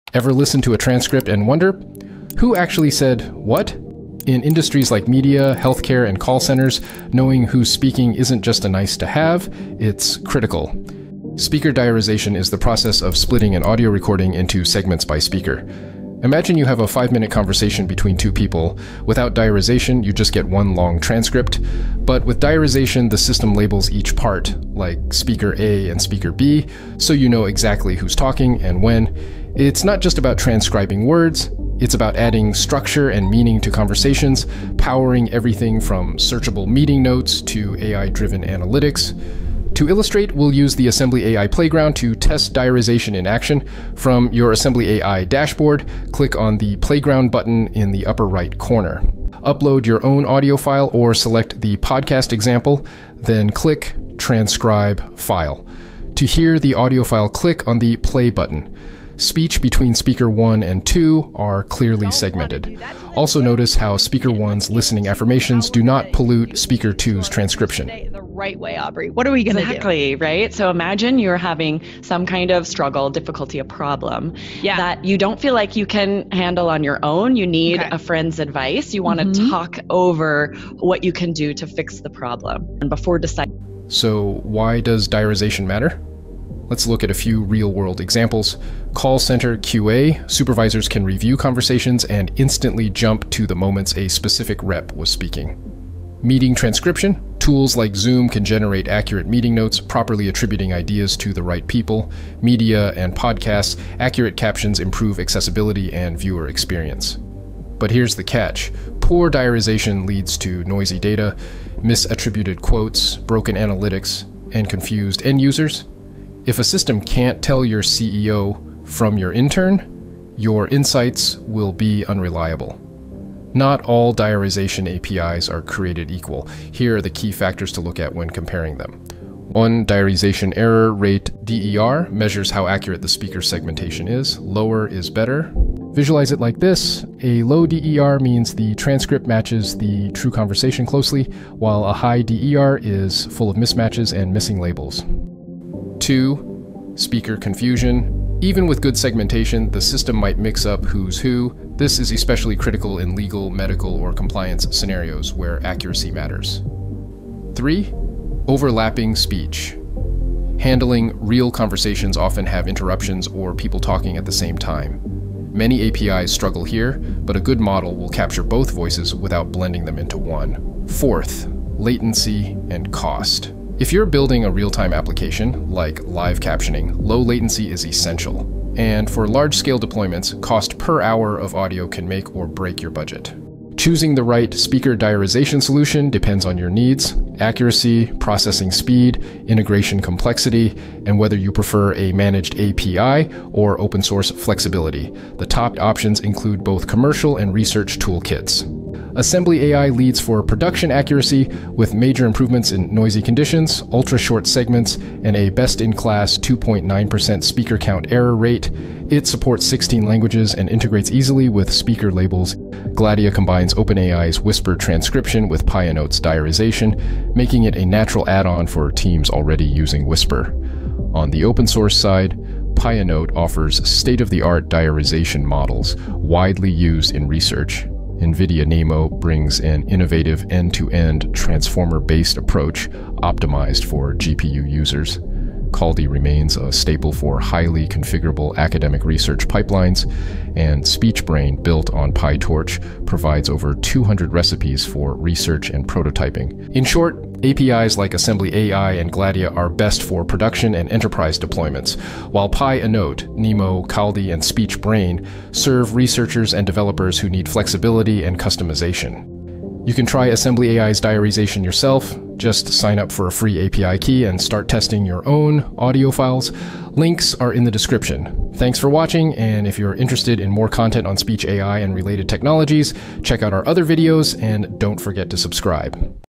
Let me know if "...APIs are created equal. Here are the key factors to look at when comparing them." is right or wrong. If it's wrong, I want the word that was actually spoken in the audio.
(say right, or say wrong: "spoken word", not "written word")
right.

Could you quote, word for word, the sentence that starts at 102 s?
Media and podcasts, accurate captions improve accessibility and viewer experience.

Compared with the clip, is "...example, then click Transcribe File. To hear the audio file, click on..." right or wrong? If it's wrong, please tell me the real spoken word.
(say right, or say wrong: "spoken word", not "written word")
right.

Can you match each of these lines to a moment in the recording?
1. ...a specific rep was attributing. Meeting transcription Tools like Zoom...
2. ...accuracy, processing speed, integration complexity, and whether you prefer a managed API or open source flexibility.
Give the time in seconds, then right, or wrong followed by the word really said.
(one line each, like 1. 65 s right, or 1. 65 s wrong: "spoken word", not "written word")
1. 93 s wrong: "speaking", not "attributing"
2. 187 s right.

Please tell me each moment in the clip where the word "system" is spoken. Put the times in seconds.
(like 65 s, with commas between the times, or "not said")
23 s, 116 s, 149 s.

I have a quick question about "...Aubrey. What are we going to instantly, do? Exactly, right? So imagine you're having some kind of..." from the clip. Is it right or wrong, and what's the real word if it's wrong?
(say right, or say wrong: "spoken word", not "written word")
wrong: "exactly", not "instantly".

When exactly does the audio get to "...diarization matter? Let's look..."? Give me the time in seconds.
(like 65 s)
85 s.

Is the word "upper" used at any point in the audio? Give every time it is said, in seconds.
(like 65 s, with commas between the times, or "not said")
48 s.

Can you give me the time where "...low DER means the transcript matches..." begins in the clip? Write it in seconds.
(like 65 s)
137 s.